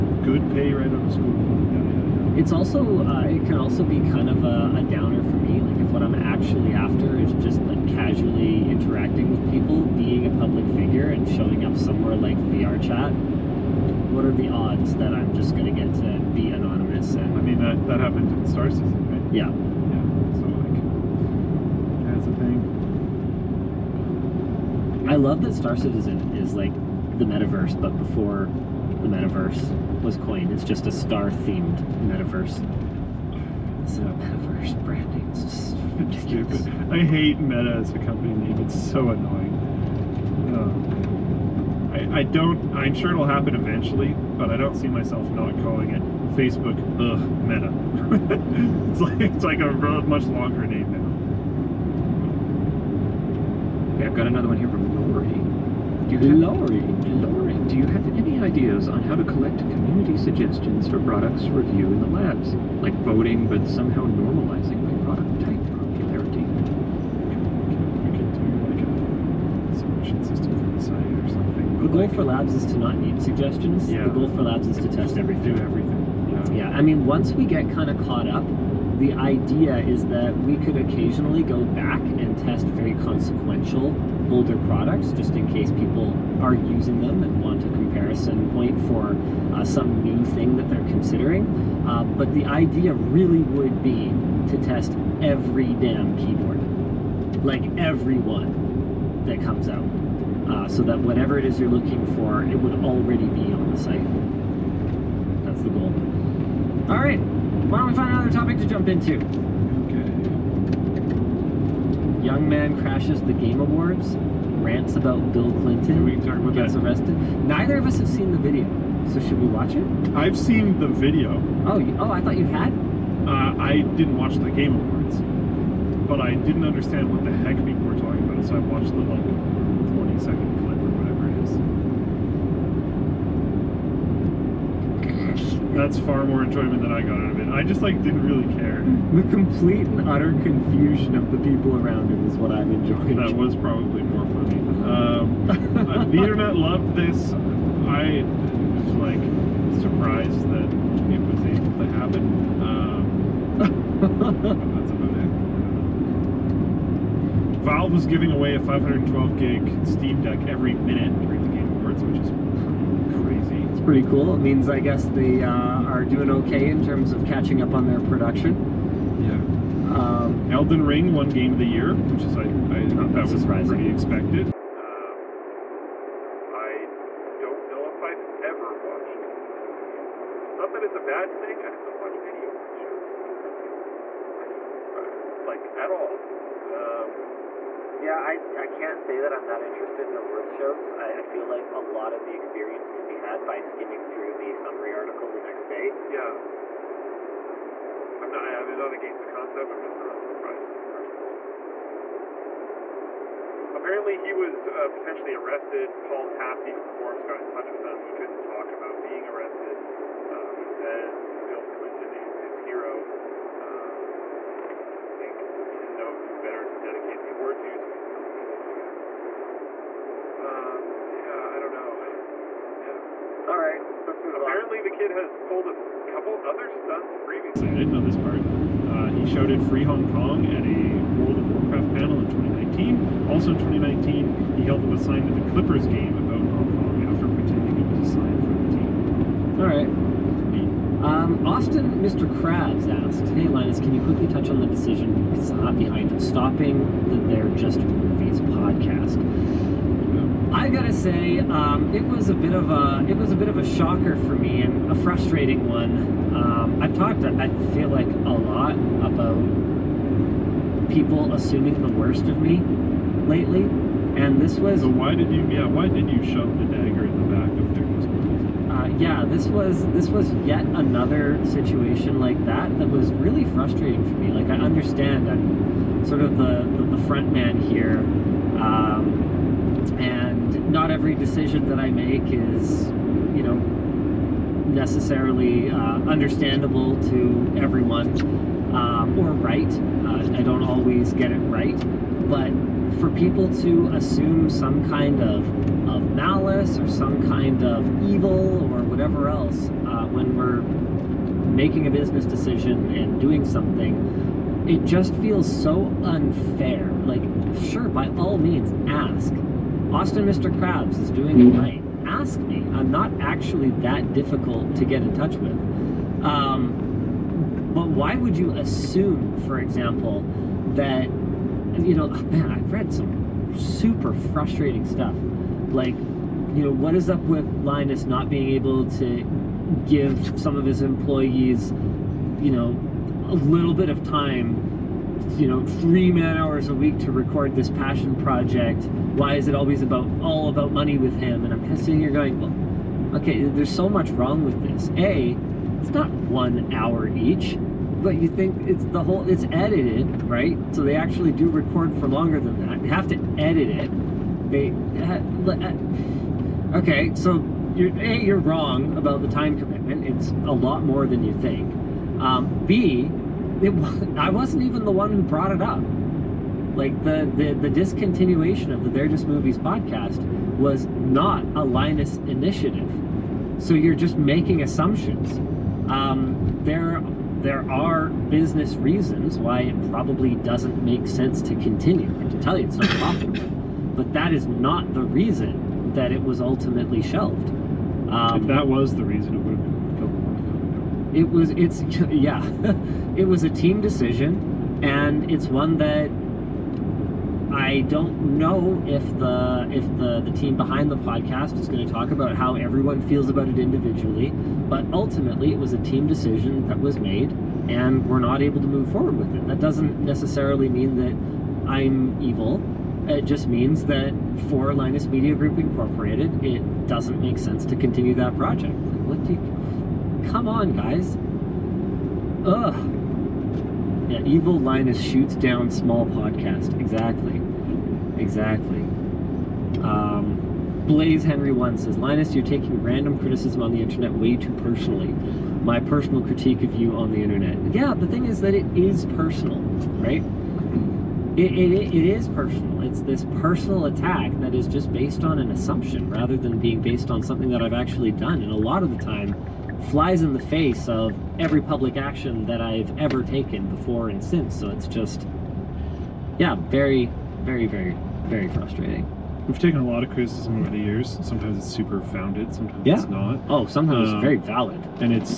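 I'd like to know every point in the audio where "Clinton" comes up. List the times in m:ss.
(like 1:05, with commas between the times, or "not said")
1:55, 3:31.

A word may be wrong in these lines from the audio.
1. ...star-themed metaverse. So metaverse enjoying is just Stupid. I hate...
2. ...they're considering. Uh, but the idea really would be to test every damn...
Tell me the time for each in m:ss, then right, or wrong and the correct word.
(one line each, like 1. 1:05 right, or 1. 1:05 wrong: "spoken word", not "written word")
1. 0:30 wrong: "branding", not "enjoying"
2. 1:30 right.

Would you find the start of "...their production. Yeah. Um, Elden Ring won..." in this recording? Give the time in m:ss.
2:47.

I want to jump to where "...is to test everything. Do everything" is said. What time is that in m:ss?
1:14.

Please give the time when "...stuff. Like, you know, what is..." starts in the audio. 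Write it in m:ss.
5:24.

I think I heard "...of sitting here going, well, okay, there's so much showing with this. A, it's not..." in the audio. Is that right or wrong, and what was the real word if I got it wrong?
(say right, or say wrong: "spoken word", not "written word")
wrong: "wrong", not "showing".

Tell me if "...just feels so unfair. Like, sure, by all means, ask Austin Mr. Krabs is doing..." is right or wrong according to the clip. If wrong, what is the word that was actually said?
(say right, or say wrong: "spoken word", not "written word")
right.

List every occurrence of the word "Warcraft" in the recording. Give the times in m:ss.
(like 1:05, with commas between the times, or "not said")
3:51.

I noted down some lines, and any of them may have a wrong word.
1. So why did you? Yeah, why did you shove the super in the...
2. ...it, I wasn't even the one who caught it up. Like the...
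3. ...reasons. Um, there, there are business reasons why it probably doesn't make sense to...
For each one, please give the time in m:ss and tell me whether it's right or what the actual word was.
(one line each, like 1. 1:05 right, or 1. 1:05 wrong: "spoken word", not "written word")
1. 4:24 wrong: "dagger", not "super"
2. 6:03 wrong: "brought", not "caught"
3. 6:14 wrong: "assumptions", not "reasons".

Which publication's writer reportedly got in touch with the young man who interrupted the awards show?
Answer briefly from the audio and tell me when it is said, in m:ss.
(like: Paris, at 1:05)
Forbes, at 3:26.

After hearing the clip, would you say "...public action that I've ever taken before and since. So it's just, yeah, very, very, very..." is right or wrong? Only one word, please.
right.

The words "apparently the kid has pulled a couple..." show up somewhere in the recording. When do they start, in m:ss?
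3:44.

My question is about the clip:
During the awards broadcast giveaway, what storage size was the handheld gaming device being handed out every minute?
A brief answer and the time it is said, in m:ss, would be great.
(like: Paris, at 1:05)
512 gig, at 2:38.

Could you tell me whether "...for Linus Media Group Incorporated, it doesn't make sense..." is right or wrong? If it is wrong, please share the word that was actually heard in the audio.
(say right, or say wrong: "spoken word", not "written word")
right.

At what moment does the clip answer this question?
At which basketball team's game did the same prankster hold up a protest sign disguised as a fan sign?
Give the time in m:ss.
3:55.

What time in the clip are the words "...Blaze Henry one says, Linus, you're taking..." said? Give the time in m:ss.
7:10.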